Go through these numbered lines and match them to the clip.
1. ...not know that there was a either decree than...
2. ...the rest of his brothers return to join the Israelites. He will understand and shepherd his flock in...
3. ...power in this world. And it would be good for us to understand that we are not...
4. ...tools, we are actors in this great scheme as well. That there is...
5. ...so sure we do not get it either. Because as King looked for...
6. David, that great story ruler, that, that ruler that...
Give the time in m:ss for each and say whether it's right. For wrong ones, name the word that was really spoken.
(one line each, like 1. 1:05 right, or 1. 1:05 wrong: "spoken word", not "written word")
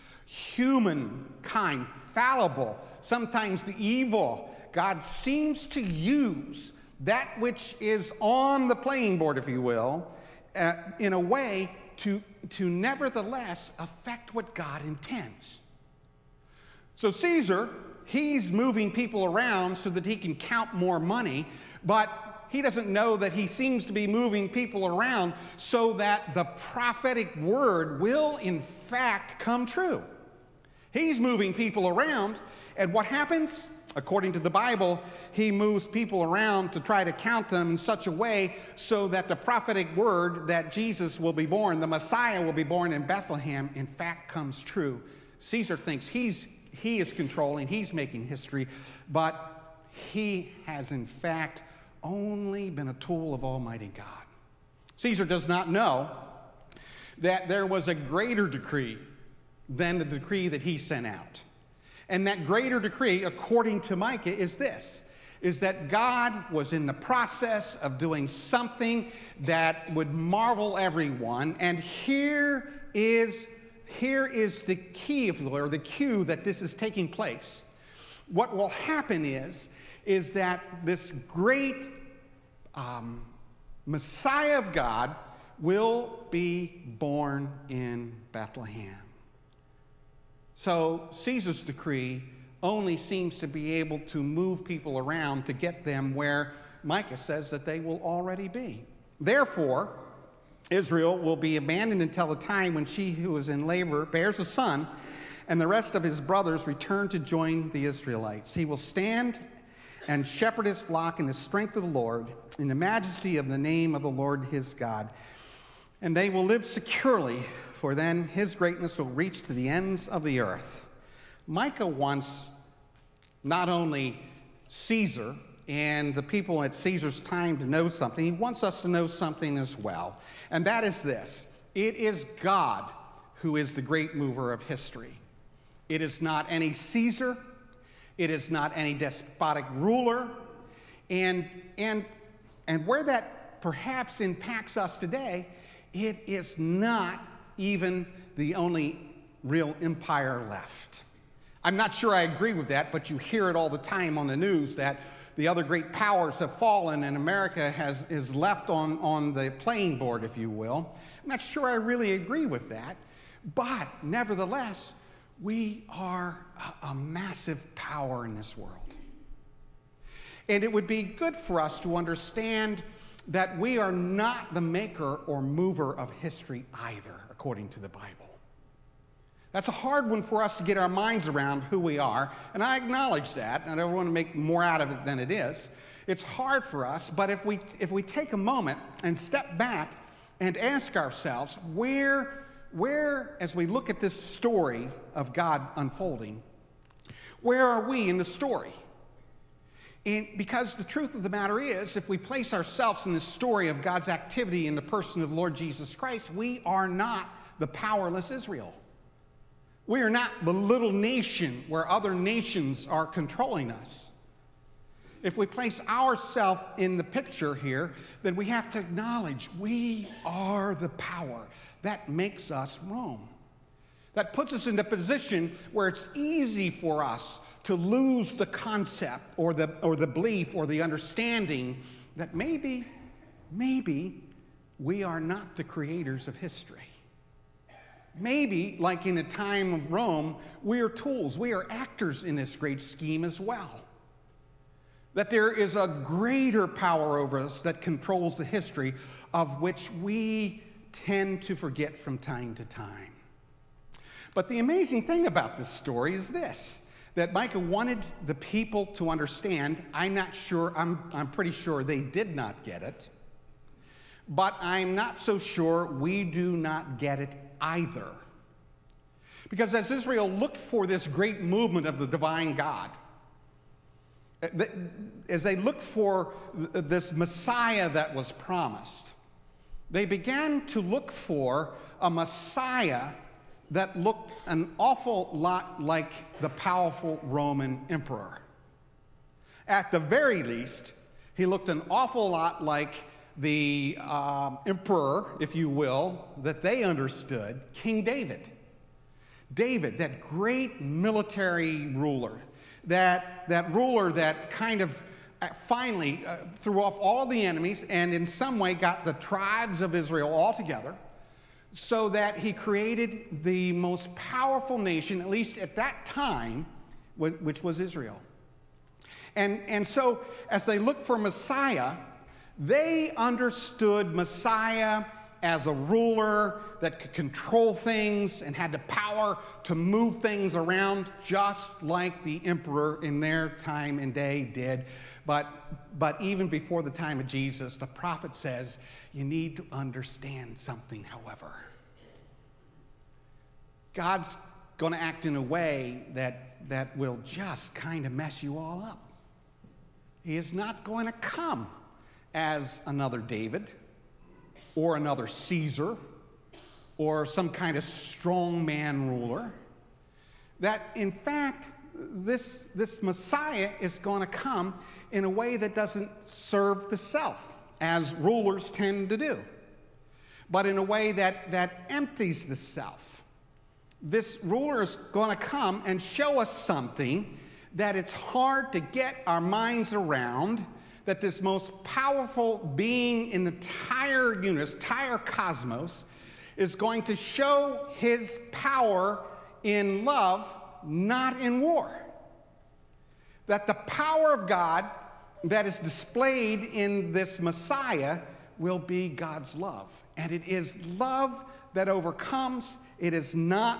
1. 0:55 wrong: "greater", not "either"
2. 1:45 wrong: "stand", not "understand"
3. 2:47 right
4. 4:00 right
5. 4:25 wrong: "Israel", not "King"
6. 4:59 wrong: "military", not "story".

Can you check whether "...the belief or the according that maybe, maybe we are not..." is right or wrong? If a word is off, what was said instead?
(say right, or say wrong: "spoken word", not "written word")
wrong: "understanding", not "according".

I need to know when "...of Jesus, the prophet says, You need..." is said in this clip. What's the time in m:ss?
5:37.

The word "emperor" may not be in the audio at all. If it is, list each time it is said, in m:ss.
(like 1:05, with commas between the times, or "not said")
4:47, 4:54, 5:32.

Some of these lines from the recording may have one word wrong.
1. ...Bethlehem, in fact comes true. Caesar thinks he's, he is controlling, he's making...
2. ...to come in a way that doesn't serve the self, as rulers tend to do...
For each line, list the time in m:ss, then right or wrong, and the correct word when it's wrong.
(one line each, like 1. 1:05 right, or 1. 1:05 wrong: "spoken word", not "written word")
1. 0:43 right
2. 6:04 right.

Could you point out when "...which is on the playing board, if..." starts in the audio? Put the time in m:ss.
0:07.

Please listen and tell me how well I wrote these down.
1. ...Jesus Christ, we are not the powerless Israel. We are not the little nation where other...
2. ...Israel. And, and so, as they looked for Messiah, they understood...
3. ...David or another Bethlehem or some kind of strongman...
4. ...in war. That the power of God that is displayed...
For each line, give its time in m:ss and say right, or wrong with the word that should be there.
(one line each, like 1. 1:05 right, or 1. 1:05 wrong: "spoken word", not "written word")
1. 3:25 right
2. 5:17 right
3. 5:53 wrong: "Caesar", not "Bethlehem"
4. 6:31 right.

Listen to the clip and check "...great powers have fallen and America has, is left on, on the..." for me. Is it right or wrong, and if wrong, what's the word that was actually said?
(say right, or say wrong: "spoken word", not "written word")
right.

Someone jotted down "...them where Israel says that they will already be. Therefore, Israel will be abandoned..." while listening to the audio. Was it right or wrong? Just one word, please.
wrong.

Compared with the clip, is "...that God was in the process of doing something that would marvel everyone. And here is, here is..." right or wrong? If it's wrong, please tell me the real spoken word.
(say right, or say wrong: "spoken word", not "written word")
right.